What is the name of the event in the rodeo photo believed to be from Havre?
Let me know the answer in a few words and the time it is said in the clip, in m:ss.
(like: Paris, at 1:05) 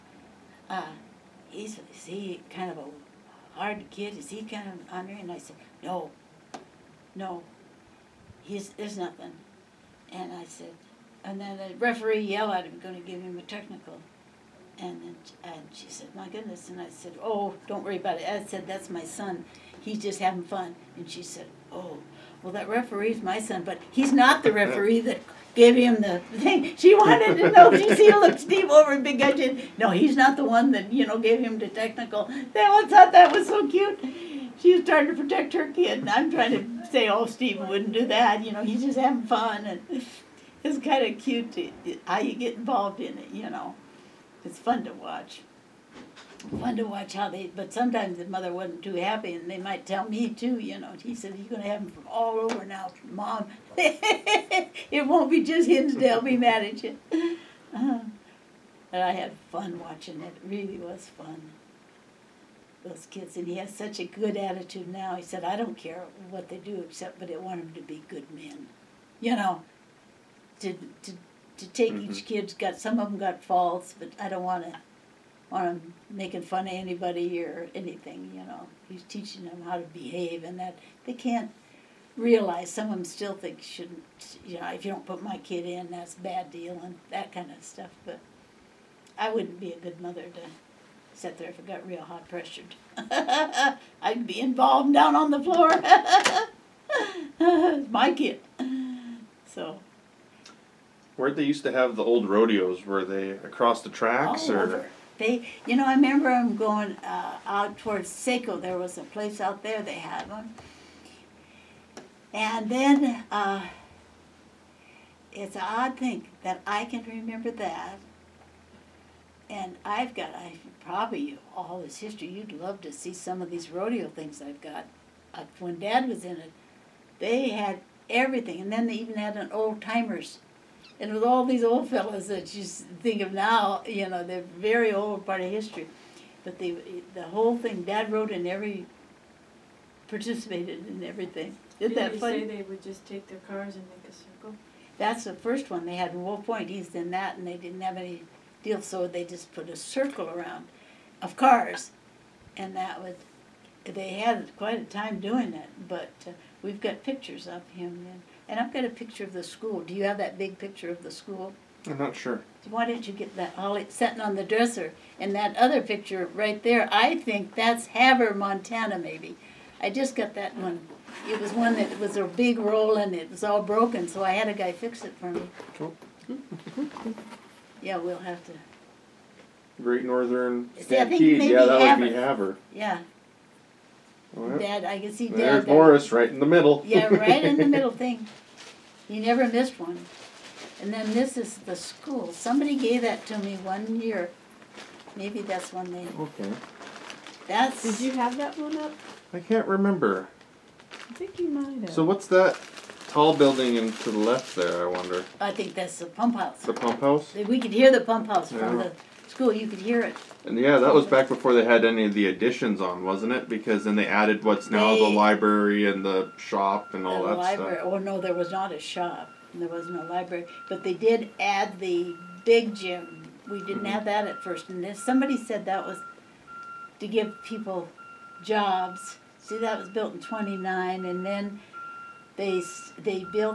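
Great Northern Stampede, at 2:59.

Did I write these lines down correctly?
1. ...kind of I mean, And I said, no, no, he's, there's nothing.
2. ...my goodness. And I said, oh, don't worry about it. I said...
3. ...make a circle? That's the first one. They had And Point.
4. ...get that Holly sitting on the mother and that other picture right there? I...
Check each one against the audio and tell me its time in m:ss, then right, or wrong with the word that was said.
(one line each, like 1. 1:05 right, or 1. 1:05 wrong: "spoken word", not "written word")
1. 0:04 right
2. 0:16 right
3. 2:23 wrong: "Wolf", not "And"
4. 2:43 wrong: "dresser", not "mother".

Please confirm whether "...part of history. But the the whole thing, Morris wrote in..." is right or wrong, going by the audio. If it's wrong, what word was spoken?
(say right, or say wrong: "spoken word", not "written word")
wrong: "Dad", not "Morris".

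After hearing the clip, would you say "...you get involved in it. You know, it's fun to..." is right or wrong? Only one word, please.
right.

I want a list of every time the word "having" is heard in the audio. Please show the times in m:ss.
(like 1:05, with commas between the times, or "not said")
0:20, 0:38.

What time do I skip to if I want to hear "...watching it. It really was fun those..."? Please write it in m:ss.
0:59.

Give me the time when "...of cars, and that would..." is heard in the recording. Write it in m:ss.
2:31.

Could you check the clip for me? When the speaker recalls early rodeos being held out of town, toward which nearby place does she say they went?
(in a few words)
Saco.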